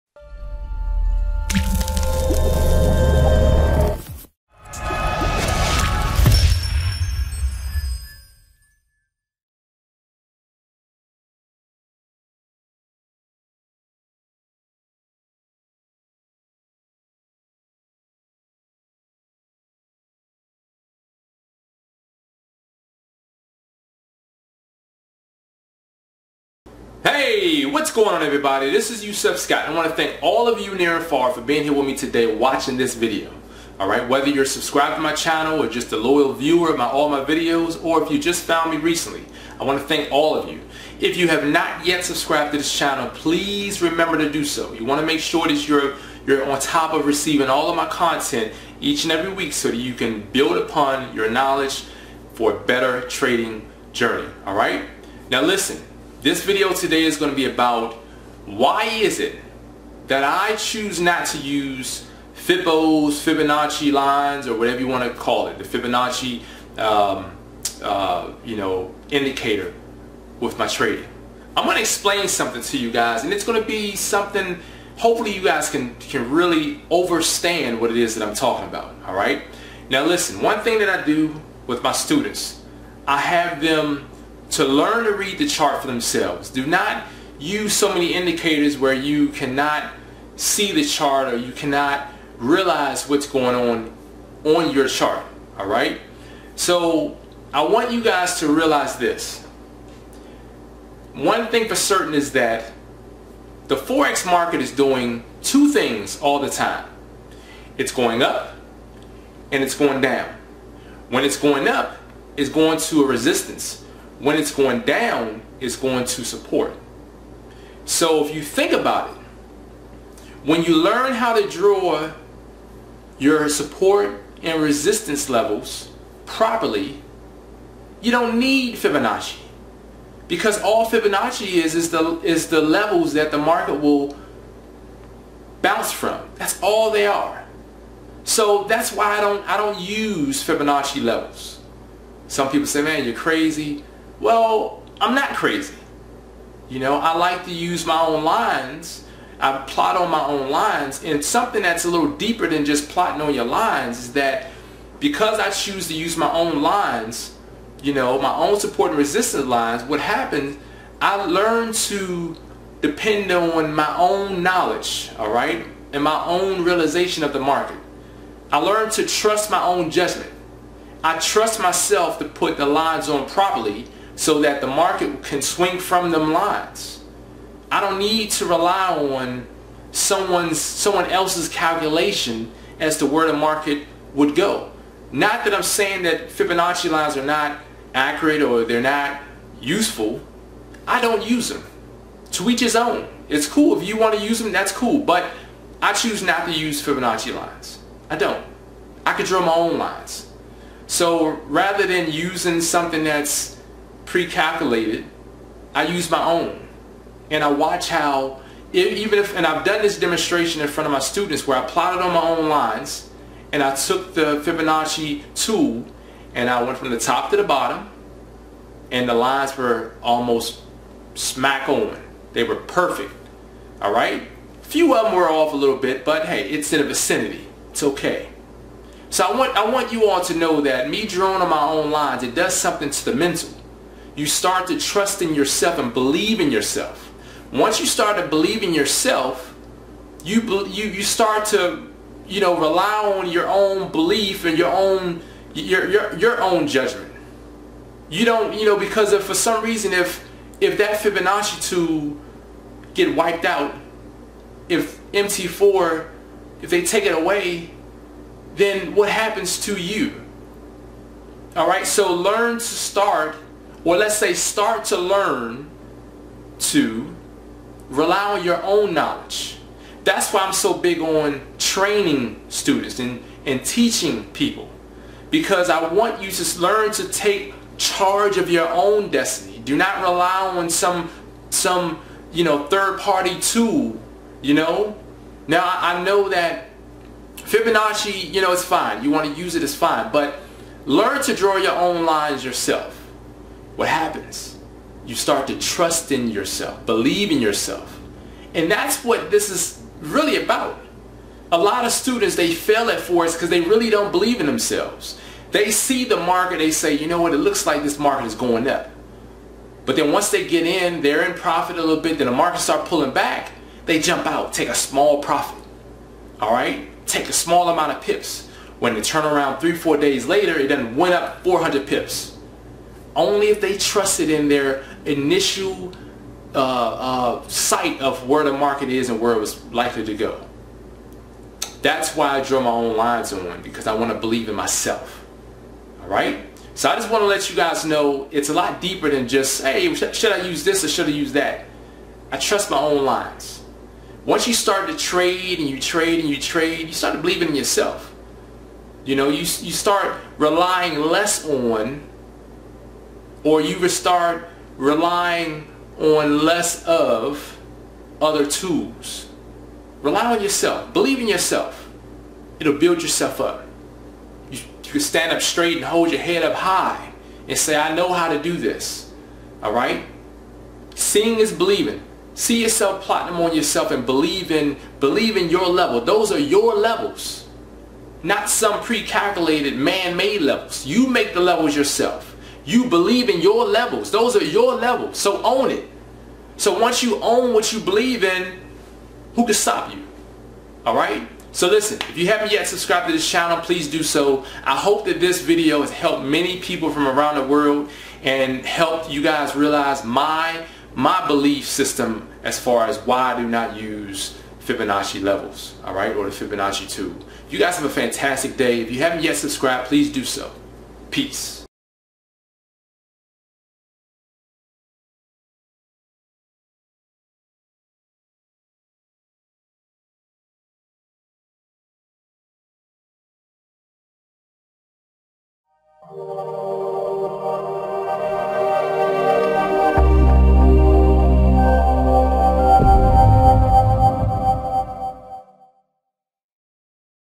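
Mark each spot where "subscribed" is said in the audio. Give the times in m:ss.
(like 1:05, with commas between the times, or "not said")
0:34, 0:42, 6:32, 6:49.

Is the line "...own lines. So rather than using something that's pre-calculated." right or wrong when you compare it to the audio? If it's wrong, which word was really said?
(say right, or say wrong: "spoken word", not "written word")
right.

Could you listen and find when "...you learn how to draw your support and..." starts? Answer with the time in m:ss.
2:00.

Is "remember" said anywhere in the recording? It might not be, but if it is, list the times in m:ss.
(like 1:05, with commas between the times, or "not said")
0:43.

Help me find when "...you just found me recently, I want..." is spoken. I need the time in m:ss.
0:38.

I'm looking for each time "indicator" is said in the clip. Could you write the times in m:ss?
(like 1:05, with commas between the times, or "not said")
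1:09, 1:28.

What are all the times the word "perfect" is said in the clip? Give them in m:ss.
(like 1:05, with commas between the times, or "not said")
3:42.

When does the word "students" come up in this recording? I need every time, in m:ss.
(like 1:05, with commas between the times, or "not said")
1:21, 3:30, 4:32, 5:01.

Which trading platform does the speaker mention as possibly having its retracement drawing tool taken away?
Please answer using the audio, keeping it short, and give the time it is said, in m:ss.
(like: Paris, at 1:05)
MT4, at 4:15.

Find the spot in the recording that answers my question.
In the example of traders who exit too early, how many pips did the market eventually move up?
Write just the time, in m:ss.
5:21.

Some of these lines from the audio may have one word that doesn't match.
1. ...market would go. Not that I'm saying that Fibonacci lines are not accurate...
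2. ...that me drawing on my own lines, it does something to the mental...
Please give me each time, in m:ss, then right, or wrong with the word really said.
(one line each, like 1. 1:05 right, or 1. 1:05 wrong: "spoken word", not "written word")
1. 3:03 right
2. 3:50 right.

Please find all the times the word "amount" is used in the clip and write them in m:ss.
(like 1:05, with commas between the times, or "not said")
5:17.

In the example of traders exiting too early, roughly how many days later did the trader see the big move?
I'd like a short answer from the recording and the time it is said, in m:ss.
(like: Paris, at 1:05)
3 or 4 days, at 5:19.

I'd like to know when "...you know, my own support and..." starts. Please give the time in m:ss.
2:37.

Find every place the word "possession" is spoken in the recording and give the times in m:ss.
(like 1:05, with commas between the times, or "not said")
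not said.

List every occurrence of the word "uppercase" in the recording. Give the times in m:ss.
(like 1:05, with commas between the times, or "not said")
not said.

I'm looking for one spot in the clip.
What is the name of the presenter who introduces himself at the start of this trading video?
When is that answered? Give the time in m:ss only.
0:29.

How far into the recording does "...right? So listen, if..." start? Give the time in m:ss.
6:30.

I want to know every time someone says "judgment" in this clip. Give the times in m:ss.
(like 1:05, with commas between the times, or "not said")
2:49, 4:06.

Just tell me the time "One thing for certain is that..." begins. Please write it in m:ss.
1:41.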